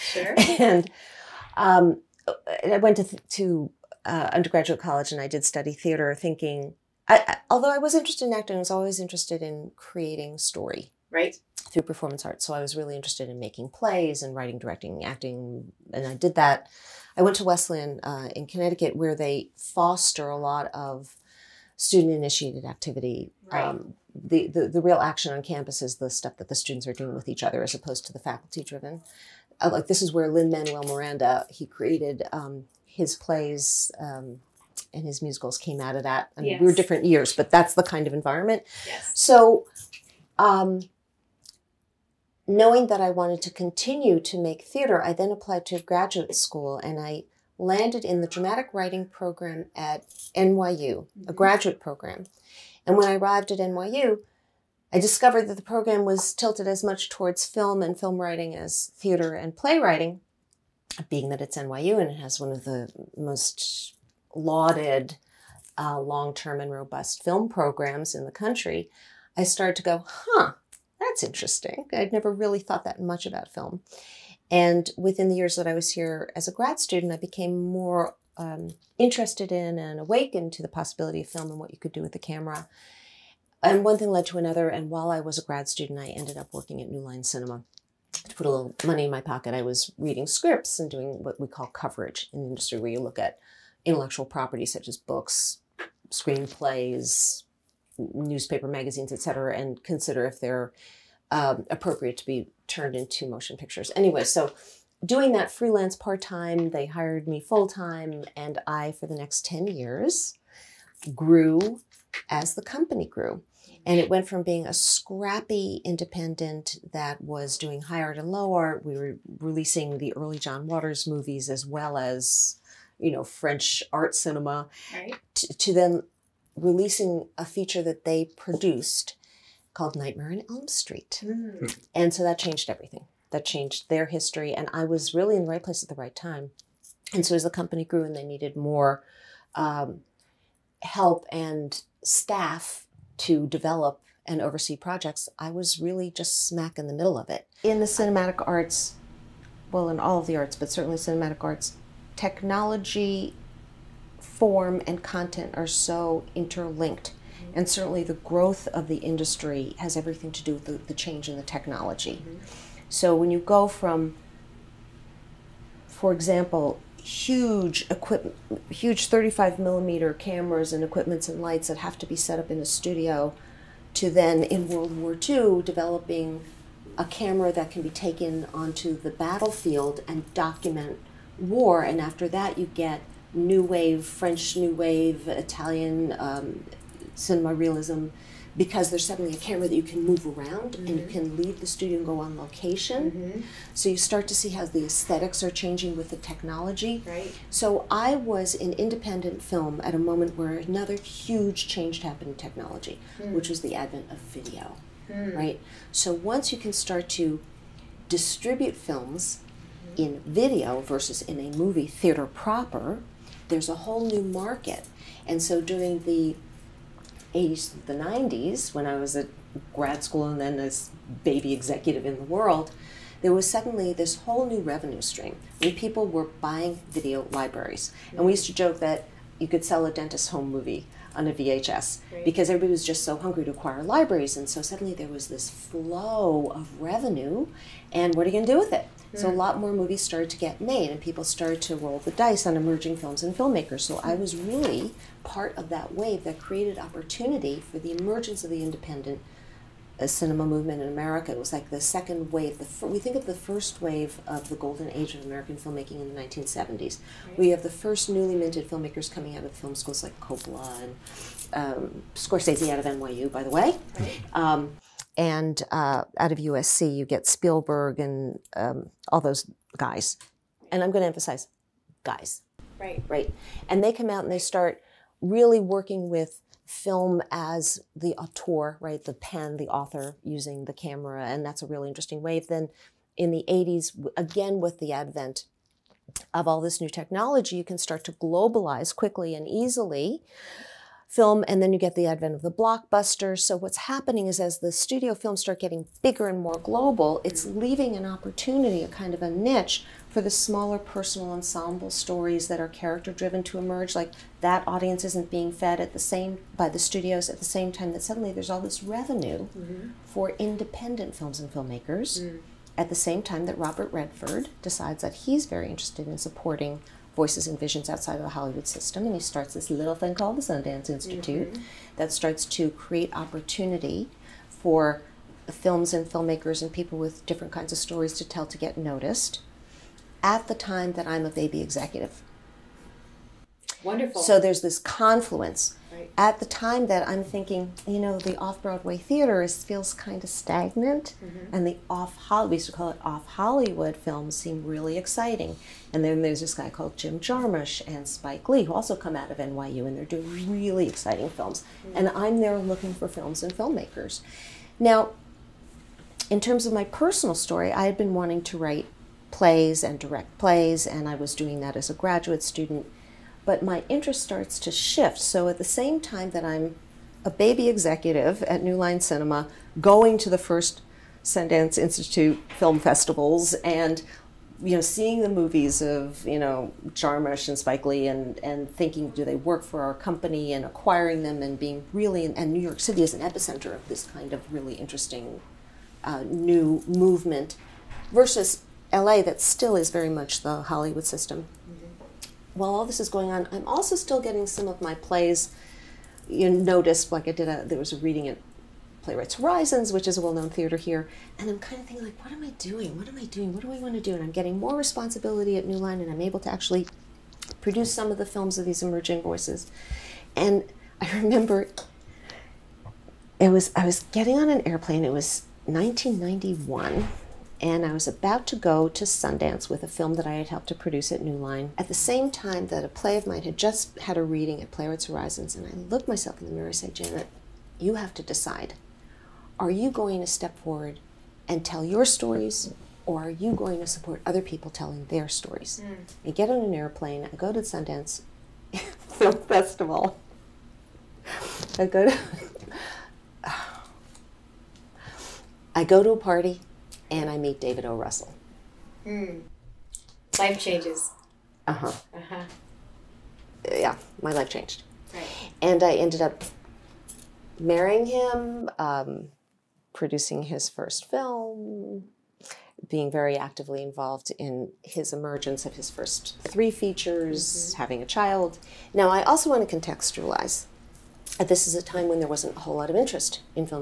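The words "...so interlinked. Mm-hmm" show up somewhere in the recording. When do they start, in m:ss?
2:35.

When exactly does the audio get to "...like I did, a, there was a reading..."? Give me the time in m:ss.
6:37.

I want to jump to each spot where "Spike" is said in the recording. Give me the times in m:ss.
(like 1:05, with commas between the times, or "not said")
5:48, 6:17.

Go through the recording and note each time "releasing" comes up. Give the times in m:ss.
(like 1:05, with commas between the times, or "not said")
1:59, 2:06.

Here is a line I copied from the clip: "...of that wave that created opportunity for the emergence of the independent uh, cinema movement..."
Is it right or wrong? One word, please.
right.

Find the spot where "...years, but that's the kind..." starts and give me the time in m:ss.
0:37.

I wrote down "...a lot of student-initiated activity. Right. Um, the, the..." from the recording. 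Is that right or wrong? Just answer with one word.
right.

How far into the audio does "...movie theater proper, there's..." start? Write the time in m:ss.
3:31.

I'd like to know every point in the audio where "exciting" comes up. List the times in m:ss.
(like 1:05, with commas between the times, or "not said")
5:44, 5:50.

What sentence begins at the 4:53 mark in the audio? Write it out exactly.
So what's happening is as the studio films start getting bigger and more global, it's mm-hmm.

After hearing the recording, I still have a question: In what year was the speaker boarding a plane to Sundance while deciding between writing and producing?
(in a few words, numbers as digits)
1991.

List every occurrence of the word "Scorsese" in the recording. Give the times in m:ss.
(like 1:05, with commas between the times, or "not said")
4:22.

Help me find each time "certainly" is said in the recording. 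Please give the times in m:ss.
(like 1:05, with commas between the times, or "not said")
2:30, 2:37.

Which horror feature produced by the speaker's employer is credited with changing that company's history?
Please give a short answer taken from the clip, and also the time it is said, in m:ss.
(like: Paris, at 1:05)
Nightmare in Elm Street, at 2:09.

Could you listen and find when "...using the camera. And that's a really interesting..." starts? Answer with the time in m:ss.
4:40.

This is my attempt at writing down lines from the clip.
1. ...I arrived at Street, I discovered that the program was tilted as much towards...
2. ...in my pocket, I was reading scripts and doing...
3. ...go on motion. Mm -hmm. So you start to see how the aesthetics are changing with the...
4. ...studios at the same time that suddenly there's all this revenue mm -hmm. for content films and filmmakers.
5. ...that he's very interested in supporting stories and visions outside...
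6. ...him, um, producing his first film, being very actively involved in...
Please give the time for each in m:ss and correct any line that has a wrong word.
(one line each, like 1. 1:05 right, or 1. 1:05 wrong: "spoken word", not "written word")
1. 0:53 wrong: "NYU", not "Street"
2. 1:29 right
3. 3:12 wrong: "location", not "motion"
4. 5:06 wrong: "independent", not "content"
5. 5:15 wrong: "voices", not "stories"
6. 7:38 right.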